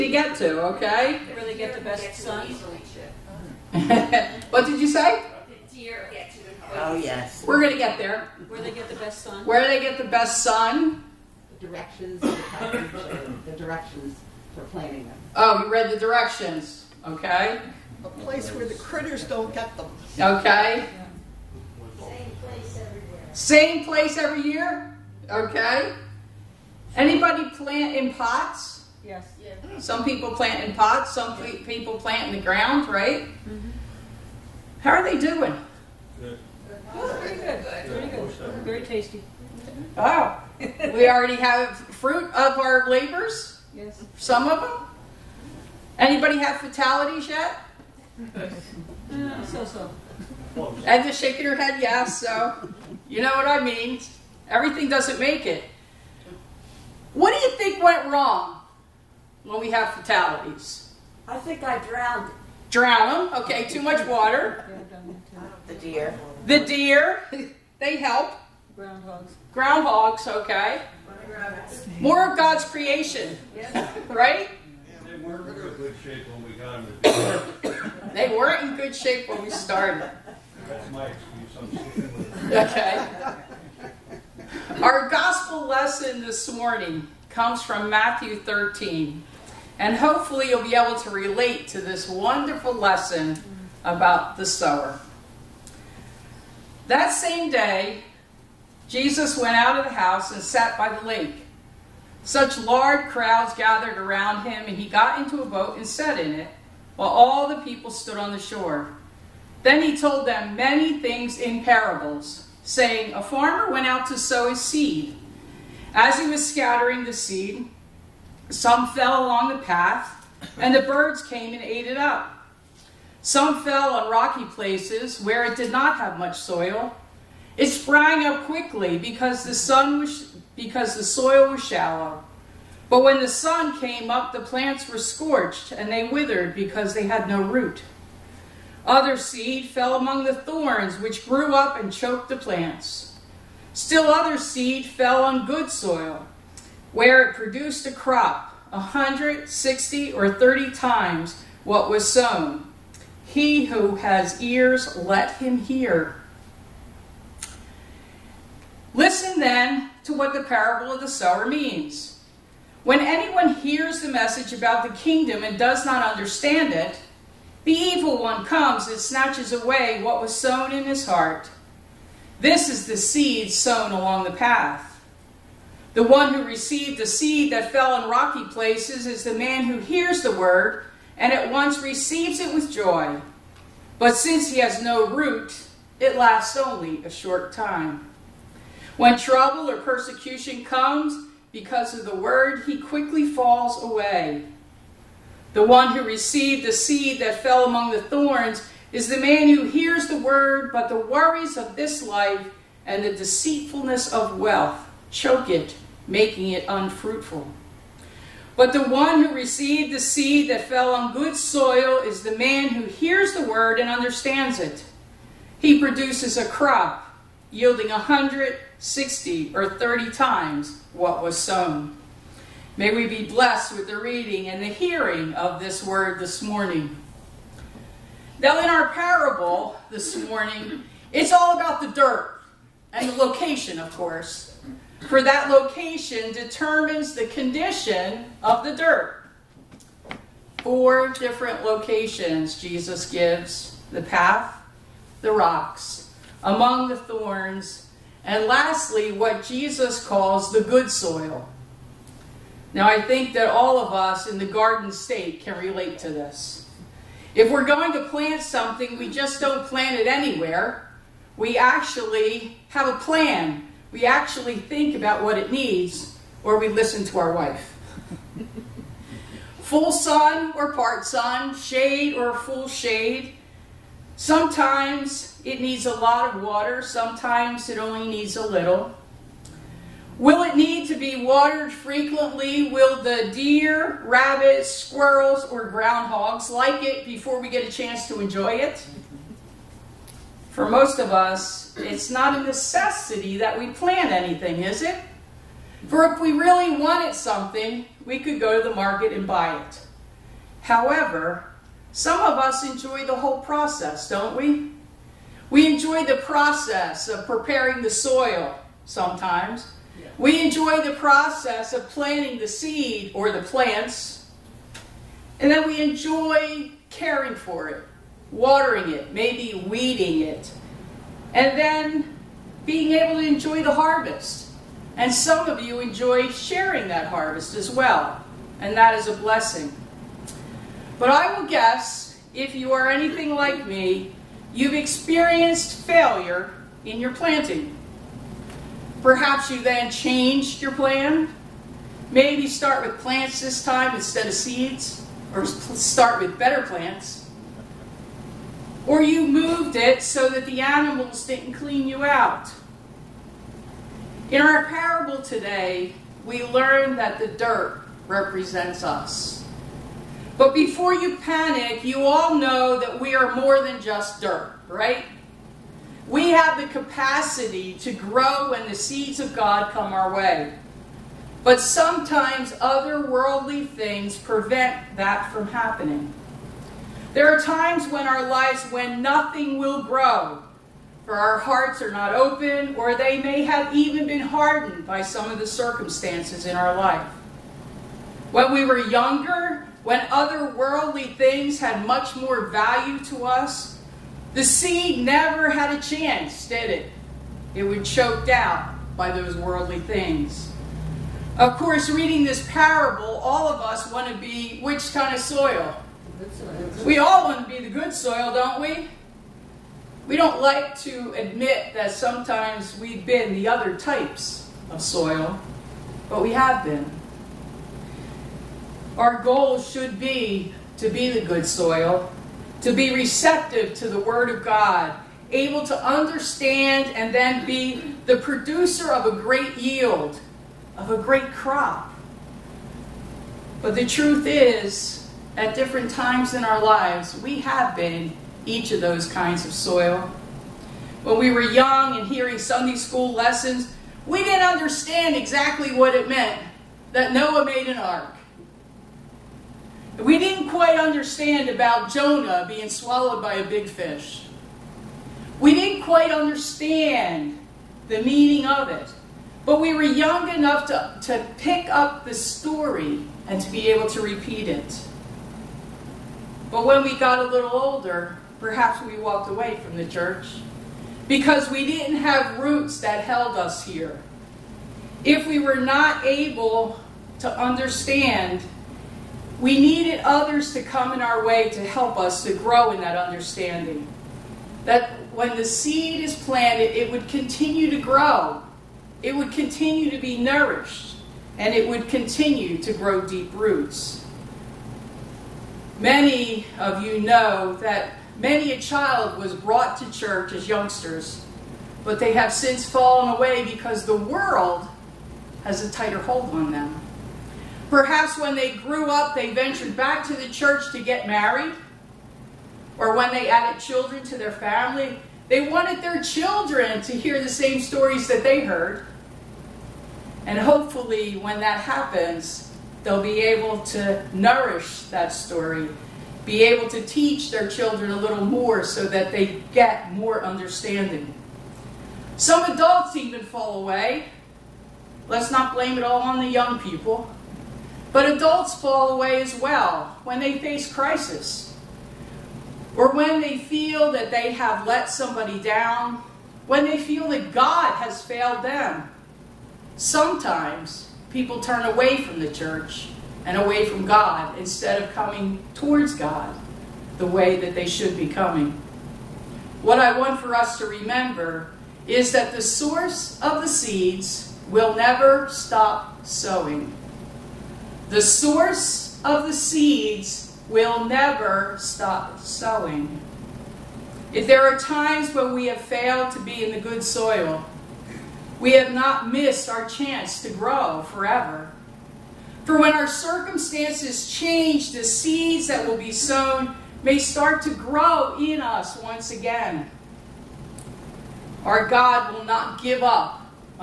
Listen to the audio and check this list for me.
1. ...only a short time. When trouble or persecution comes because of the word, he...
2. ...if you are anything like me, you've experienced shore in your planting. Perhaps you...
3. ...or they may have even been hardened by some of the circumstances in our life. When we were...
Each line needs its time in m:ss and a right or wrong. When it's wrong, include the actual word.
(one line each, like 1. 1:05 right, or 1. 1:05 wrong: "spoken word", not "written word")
1. 3:06 right
2. 5:32 wrong: "failure", not "shore"
3. 6:22 right.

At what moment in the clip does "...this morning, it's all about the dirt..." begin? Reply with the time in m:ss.
3:49.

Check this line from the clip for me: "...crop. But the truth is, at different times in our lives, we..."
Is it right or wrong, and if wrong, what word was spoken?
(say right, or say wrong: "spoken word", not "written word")
right.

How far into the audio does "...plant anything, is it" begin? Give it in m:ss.
4:53.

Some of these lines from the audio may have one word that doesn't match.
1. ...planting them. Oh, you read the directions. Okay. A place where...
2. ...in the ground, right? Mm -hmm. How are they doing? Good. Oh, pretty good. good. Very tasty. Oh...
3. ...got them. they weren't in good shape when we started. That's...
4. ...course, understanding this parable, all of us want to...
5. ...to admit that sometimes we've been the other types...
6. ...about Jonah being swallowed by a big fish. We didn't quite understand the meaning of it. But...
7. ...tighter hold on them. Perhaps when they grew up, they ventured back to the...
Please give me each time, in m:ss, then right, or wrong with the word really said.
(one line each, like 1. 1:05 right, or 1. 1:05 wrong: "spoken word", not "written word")
1. 0:14 right
2. 0:32 right
3. 1:16 right
4. 6:41 wrong: "reading", not "understanding"
5. 6:50 right
6. 7:31 right
7. 8:25 right.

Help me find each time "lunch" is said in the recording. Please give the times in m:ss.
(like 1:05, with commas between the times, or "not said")
not said.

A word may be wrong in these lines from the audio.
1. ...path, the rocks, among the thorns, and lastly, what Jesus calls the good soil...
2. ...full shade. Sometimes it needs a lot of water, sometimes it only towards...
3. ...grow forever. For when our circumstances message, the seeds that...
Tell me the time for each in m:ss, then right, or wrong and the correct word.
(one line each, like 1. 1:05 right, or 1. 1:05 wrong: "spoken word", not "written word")
1. 4:04 right
2. 4:32 wrong: "needs", not "towards"
3. 9:40 wrong: "change", not "message".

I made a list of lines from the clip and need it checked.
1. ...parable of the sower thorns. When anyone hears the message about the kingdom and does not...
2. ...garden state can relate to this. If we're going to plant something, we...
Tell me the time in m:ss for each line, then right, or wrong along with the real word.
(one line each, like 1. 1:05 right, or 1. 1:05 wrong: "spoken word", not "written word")
1. 2:40 wrong: "means", not "thorns"
2. 4:14 right.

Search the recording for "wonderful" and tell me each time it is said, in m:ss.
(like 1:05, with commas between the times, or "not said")
1:32.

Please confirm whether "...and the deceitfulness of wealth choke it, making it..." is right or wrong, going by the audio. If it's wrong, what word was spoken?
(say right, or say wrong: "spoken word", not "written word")
right.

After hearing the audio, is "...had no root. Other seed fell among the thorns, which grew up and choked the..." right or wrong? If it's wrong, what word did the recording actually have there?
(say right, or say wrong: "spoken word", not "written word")
right.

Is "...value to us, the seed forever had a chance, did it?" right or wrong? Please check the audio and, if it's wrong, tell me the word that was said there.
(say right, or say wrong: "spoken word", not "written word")
wrong: "never", not "forever".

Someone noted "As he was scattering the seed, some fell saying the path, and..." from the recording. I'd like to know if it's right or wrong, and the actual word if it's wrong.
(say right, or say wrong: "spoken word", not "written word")
wrong: "along", not "saying".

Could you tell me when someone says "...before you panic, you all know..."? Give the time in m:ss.
6:00.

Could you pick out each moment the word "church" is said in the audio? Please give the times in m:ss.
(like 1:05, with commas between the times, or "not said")
7:49, 8:19, 8:30, 9:12.